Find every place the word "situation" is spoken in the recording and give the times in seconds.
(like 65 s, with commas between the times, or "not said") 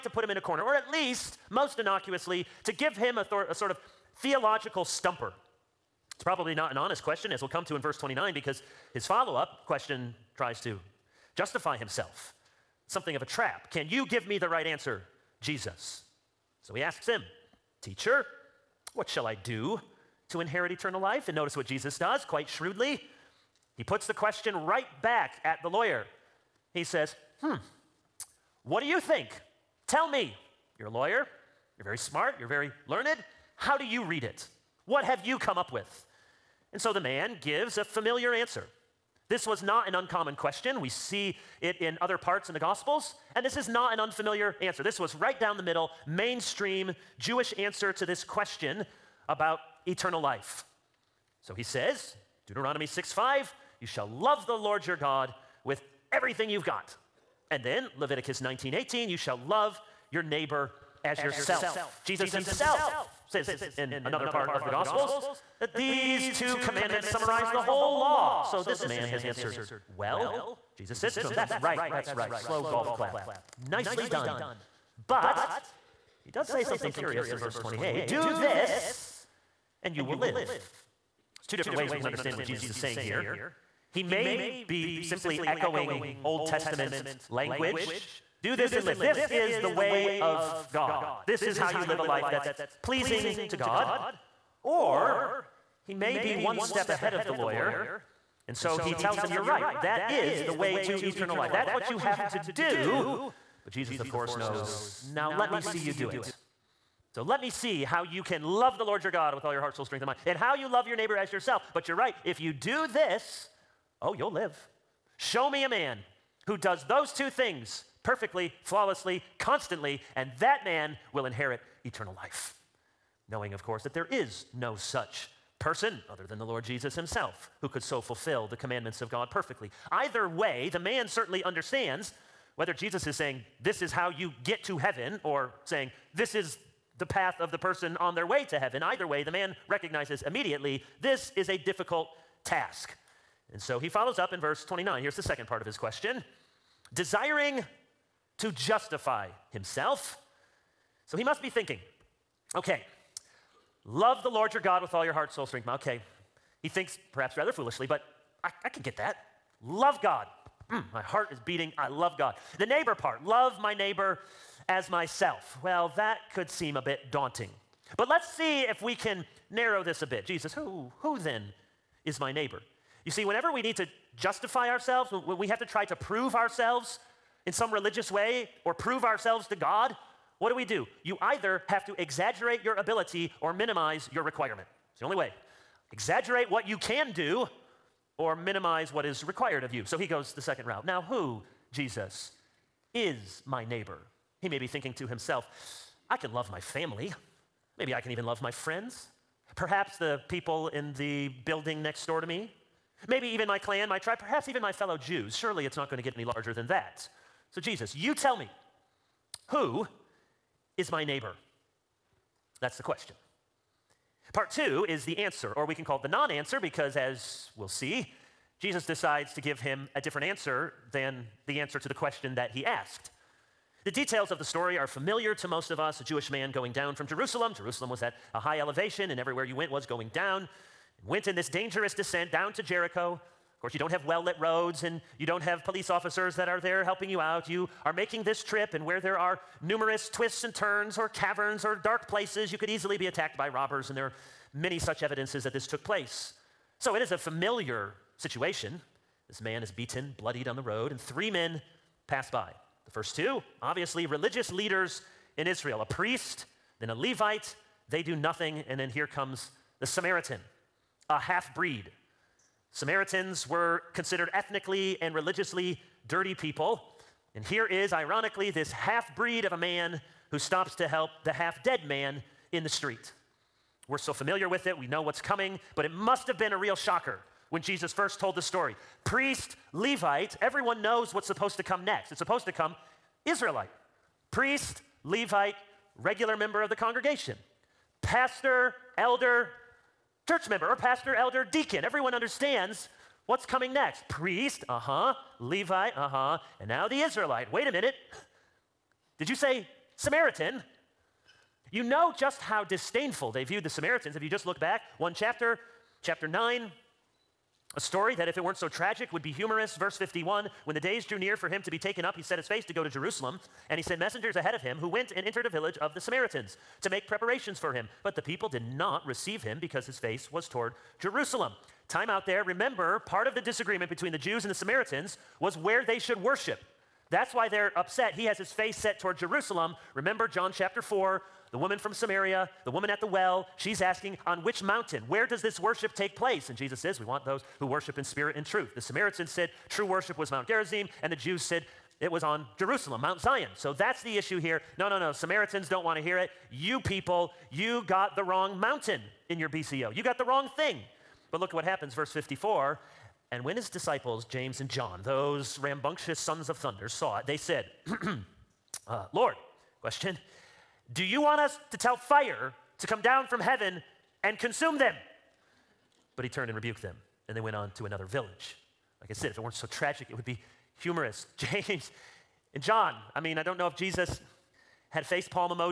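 248 s.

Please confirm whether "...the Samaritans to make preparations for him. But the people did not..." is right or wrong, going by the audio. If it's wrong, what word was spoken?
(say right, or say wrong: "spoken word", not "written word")
right.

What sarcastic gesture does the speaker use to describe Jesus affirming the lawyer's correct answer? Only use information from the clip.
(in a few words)
Slow golf clap.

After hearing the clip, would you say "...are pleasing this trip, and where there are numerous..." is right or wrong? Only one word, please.
wrong.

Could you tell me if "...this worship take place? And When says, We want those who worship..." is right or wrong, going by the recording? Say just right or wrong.
wrong.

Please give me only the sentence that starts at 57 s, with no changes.
And then Leviticus nineteen eighteen, you shall love your neighbor as yourself.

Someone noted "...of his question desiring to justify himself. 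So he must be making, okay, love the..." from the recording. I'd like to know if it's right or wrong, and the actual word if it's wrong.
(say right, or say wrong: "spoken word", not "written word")
wrong: "thinking", not "making".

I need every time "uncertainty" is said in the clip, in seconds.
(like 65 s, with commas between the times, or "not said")
not said.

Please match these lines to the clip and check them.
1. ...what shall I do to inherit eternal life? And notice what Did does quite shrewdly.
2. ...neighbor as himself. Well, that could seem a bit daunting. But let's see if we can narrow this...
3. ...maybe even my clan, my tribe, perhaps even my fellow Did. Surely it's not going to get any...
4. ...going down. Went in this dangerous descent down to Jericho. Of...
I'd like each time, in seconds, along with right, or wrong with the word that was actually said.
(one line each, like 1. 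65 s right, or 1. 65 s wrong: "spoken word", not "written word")
1. 18 s wrong: "Jesus", not "Did"
2. 163 s wrong: "myself", not "himself"
3. 203 s wrong: "Jews", not "Did"
4. 229 s right.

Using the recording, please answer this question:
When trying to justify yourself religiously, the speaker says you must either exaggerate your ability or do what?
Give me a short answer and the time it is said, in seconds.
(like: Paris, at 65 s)
Minimize your requirement, at 183 s.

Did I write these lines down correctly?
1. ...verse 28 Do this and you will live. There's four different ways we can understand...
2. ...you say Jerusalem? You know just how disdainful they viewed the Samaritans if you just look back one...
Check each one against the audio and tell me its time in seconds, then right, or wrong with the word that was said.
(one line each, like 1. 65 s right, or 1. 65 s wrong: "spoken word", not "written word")
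1. 77 s wrong: "two", not "four"
2. 299 s wrong: "Samaritan", not "Jerusalem".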